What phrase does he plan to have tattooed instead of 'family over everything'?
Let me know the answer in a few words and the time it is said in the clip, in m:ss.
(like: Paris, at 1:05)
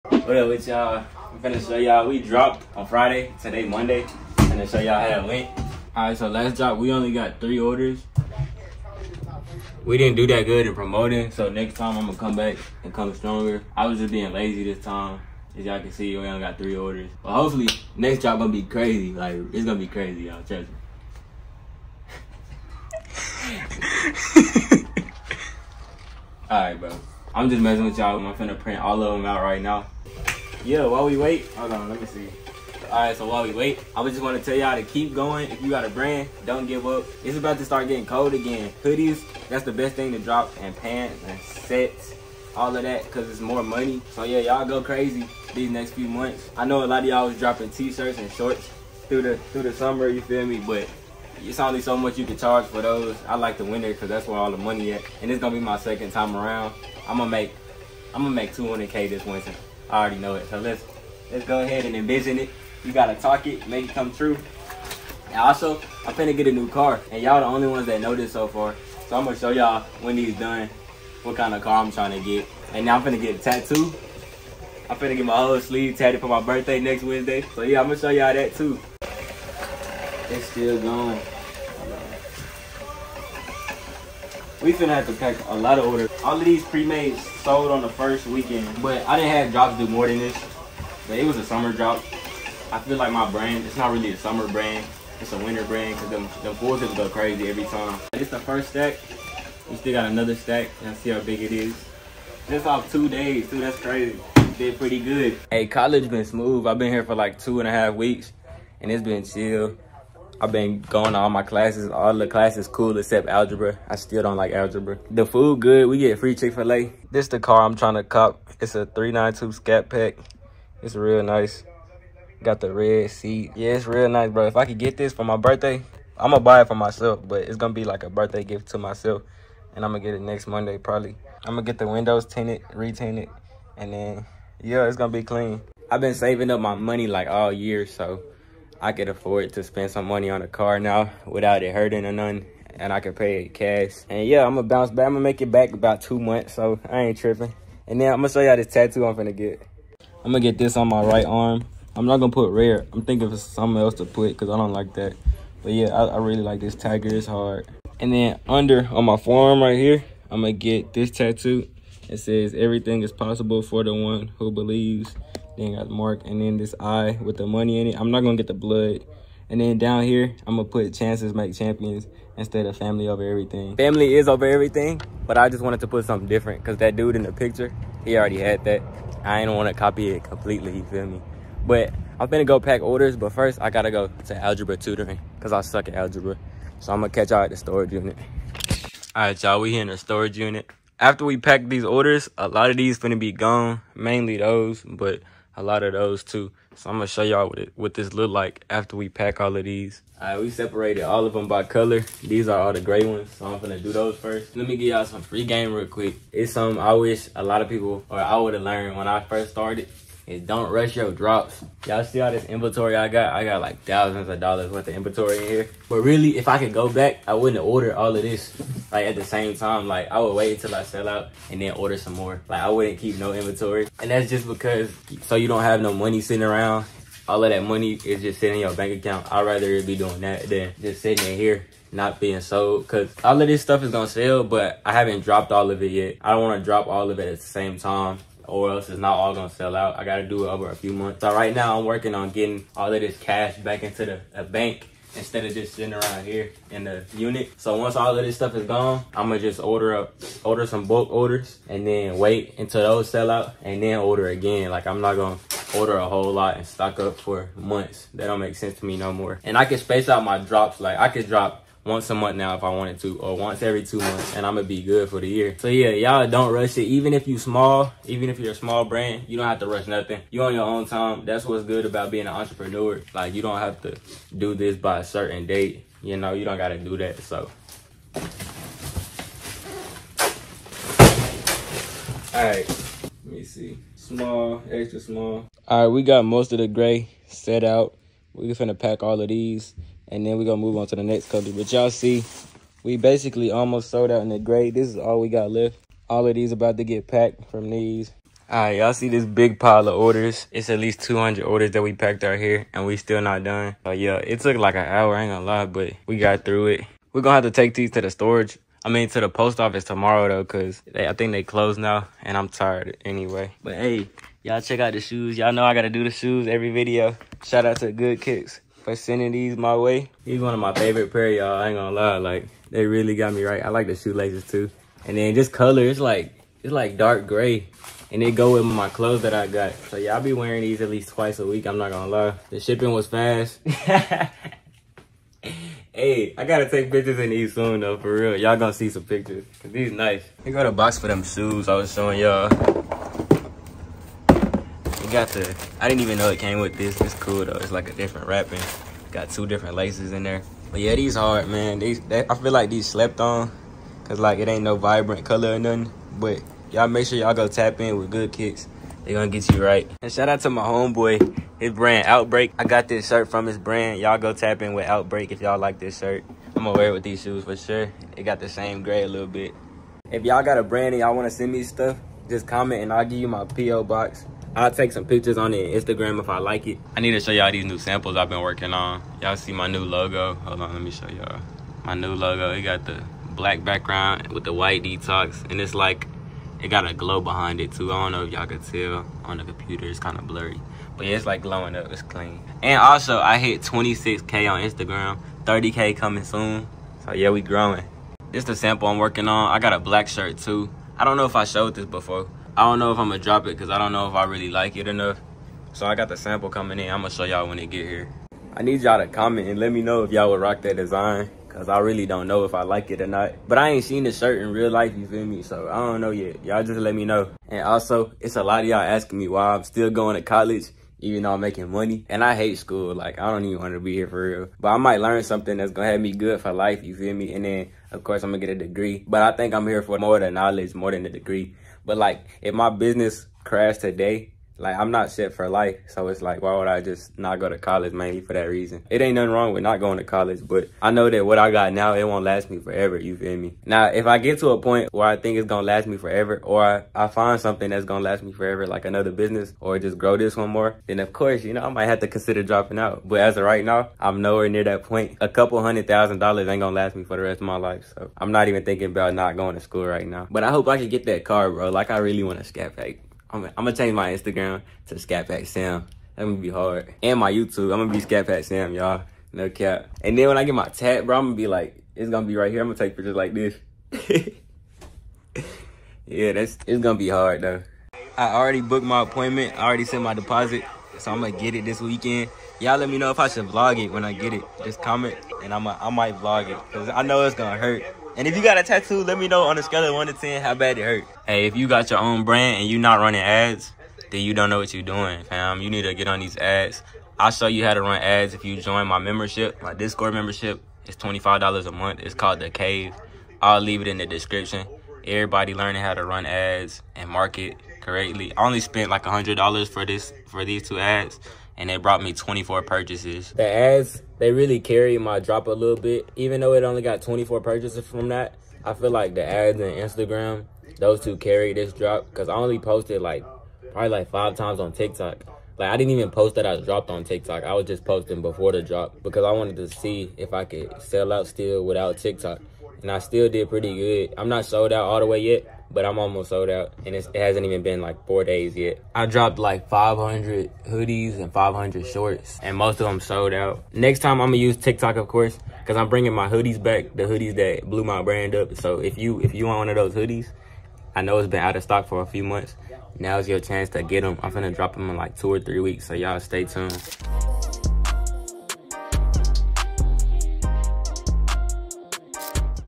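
chances make champions, at 2:50.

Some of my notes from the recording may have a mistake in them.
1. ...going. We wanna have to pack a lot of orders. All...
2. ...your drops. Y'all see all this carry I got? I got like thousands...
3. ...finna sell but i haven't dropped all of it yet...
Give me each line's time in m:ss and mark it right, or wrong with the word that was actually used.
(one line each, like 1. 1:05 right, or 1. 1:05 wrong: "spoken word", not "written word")
1. 1:20 wrong: "finna", not "wanna"
2. 3:30 wrong: "inventory", not "carry"
3. 3:53 wrong: "gonna", not "finna".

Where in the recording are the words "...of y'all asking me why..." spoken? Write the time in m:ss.
6:58.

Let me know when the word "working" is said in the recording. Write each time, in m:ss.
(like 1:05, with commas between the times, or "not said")
4:01, 6:18, 6:38.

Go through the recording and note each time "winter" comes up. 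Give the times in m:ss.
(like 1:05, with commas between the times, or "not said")
0:53, 0:59, 1:35.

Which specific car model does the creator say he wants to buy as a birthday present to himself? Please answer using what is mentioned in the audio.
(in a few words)
392 Scat Pack.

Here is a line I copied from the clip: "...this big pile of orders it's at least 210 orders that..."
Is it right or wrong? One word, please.
wrong.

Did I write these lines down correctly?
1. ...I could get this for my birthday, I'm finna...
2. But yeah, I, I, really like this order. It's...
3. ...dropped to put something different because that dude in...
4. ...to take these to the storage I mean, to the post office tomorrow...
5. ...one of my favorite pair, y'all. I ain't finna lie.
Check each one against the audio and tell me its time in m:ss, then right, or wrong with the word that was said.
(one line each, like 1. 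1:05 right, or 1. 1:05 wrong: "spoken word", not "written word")
1. 2:04 wrong: "gonna", not "finna"
2. 2:35 wrong: "tiger", not "order"
3. 2:55 wrong: "wanted", not "dropped"
4. 5:07 right
5. 5:20 wrong: "gonna", not "finna".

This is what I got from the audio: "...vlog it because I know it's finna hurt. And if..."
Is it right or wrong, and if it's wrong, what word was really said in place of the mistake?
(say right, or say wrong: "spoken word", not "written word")
wrong: "gonna", not "finna".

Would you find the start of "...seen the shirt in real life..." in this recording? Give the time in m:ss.
6:53.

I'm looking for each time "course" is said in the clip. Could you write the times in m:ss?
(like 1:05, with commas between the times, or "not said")
7:08, 7:31, 9:05.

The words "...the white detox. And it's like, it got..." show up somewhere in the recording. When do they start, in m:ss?
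6:24.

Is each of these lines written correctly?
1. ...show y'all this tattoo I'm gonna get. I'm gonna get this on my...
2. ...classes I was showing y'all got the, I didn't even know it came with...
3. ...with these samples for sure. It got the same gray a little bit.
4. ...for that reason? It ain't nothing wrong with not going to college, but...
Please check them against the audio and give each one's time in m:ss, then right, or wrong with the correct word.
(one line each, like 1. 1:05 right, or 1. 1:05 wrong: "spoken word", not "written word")
1. 2:28 right
2. 5:41 wrong: "shoes", not "classes"
3. 6:06 wrong: "shoes", not "samples"
4. 7:18 right.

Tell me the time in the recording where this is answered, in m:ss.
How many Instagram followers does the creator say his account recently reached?
6:33.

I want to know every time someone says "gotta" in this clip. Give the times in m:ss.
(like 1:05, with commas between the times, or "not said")
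1:02, 3:03, 4:00, 4:36, 5:36.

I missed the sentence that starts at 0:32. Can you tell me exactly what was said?
Alright, so while we wait, I just want to tell y'all to keep going.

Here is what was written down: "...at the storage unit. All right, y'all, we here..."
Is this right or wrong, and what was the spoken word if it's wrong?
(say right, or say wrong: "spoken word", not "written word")
right.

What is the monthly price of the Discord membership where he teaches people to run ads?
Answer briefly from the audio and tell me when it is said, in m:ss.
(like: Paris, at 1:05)
$25, at 8:20.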